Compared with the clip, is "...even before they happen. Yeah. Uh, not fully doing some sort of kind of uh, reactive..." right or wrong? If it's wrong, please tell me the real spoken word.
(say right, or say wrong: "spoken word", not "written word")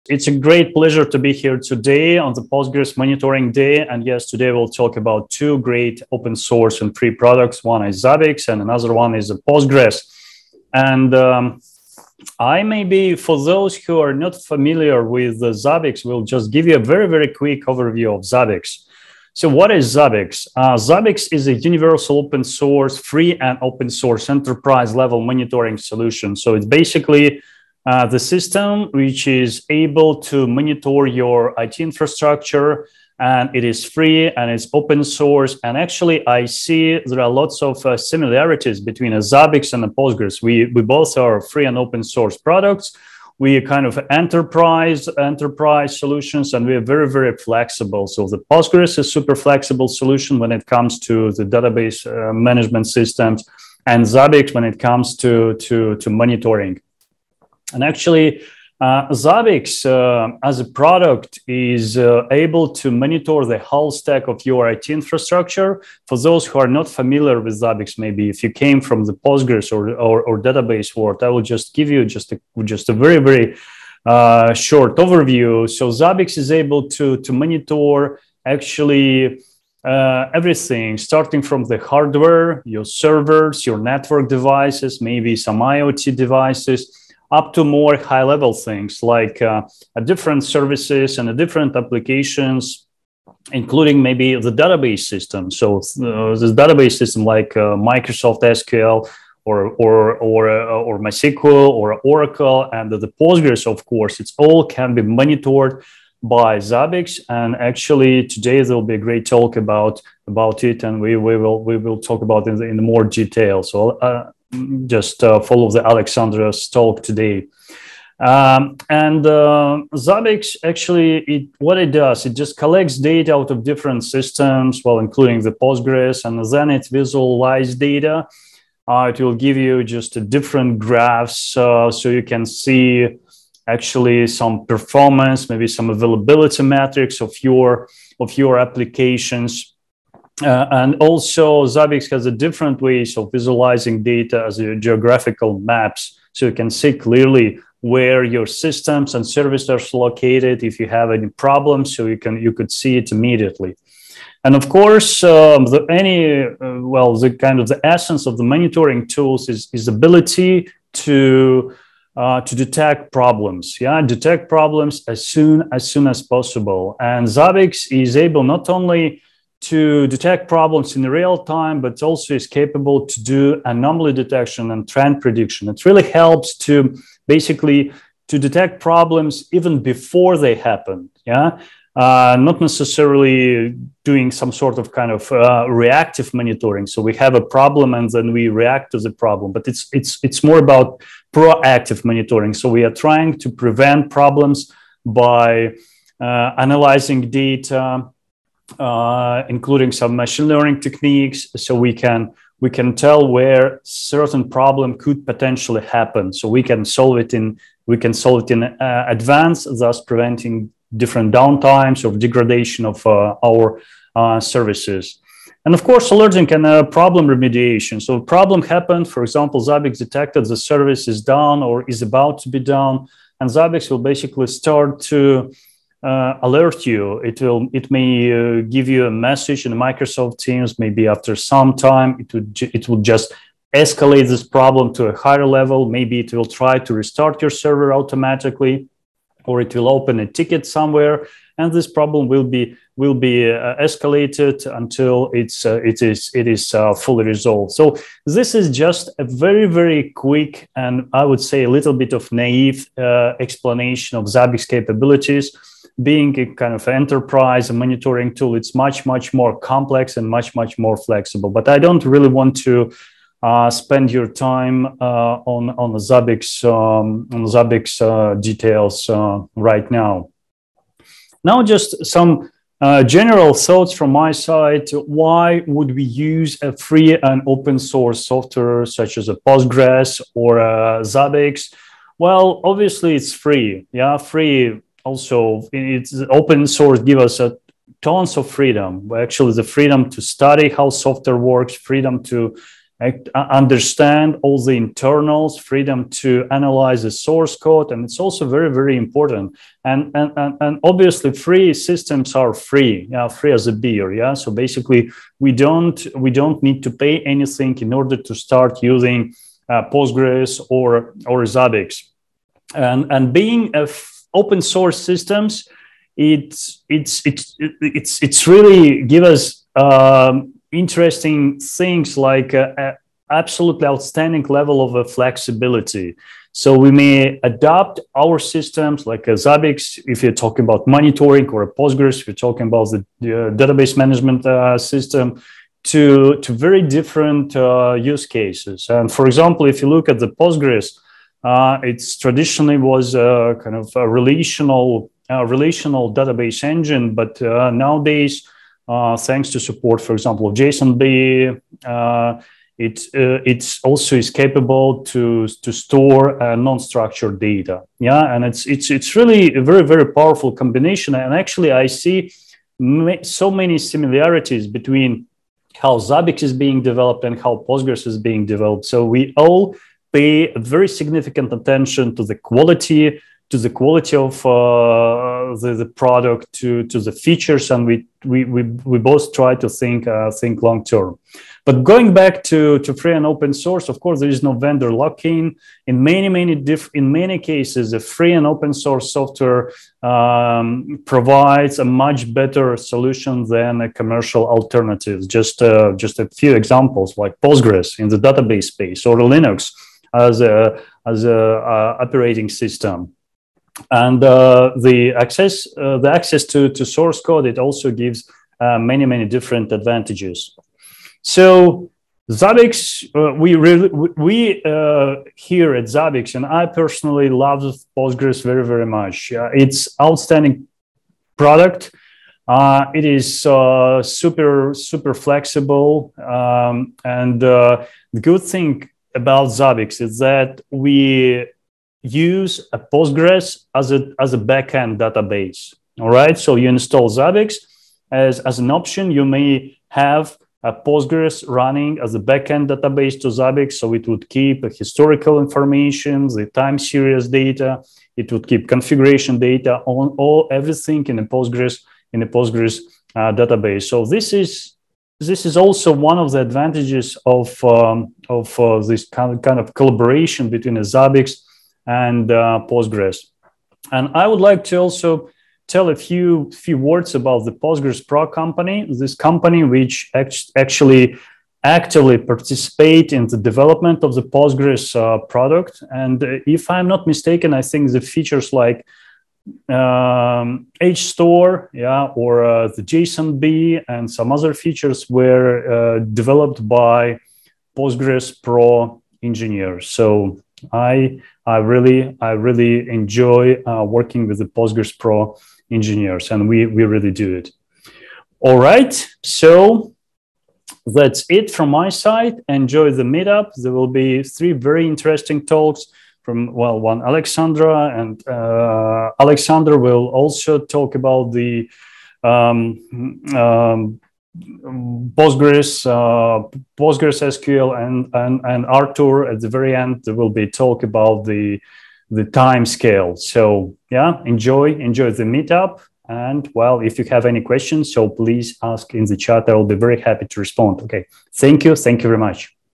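wrong: "necessarily", not "fully".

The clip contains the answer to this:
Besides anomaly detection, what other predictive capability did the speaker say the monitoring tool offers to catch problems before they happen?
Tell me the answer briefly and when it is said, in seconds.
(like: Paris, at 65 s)
trend prediction, at 174 s.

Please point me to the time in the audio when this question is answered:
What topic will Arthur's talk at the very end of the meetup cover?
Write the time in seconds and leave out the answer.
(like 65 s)
522 s.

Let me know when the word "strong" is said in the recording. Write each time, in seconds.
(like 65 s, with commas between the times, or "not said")
not said.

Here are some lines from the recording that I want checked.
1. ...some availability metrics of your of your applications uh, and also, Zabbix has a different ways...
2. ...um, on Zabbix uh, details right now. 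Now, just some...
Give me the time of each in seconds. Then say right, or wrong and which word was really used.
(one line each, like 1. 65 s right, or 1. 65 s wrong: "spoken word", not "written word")
1. 135 s right
2. 266 s right.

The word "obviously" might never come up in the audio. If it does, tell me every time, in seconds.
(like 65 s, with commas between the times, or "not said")
282 s, 300 s.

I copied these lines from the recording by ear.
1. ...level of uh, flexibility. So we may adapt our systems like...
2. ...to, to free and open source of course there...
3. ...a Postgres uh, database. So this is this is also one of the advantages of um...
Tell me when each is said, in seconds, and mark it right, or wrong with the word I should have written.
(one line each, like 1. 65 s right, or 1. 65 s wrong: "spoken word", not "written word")
1. 324 s right
2. 382 s right
3. 452 s right.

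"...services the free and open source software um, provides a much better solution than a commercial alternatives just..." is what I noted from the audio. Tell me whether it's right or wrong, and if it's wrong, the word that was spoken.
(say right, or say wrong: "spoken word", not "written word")
wrong: "cases", not "services".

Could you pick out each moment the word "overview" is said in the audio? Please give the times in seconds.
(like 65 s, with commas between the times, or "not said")
17 s, 74 s.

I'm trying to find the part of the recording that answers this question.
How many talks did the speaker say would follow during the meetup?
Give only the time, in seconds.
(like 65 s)
504 s.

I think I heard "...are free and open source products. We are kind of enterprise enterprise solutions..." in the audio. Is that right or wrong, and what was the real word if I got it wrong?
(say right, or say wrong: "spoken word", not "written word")
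right.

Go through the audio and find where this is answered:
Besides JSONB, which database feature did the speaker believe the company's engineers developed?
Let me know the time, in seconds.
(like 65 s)
480 s.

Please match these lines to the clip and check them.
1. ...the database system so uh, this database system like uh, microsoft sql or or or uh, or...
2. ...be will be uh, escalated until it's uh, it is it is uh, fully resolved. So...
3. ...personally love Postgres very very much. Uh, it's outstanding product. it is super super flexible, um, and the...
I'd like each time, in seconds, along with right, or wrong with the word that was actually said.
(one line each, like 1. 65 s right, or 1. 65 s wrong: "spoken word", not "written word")
1. 94 s right
2. 242 s right
3. 416 s right.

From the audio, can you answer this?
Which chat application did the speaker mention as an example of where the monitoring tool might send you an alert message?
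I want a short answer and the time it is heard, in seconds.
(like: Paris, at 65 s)
Microsoft Teams, at 229 s.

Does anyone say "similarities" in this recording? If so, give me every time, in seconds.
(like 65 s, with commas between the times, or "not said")
37 s, 363 s.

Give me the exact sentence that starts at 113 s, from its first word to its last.
So uh, just uh, follow the Alexandra's talk today.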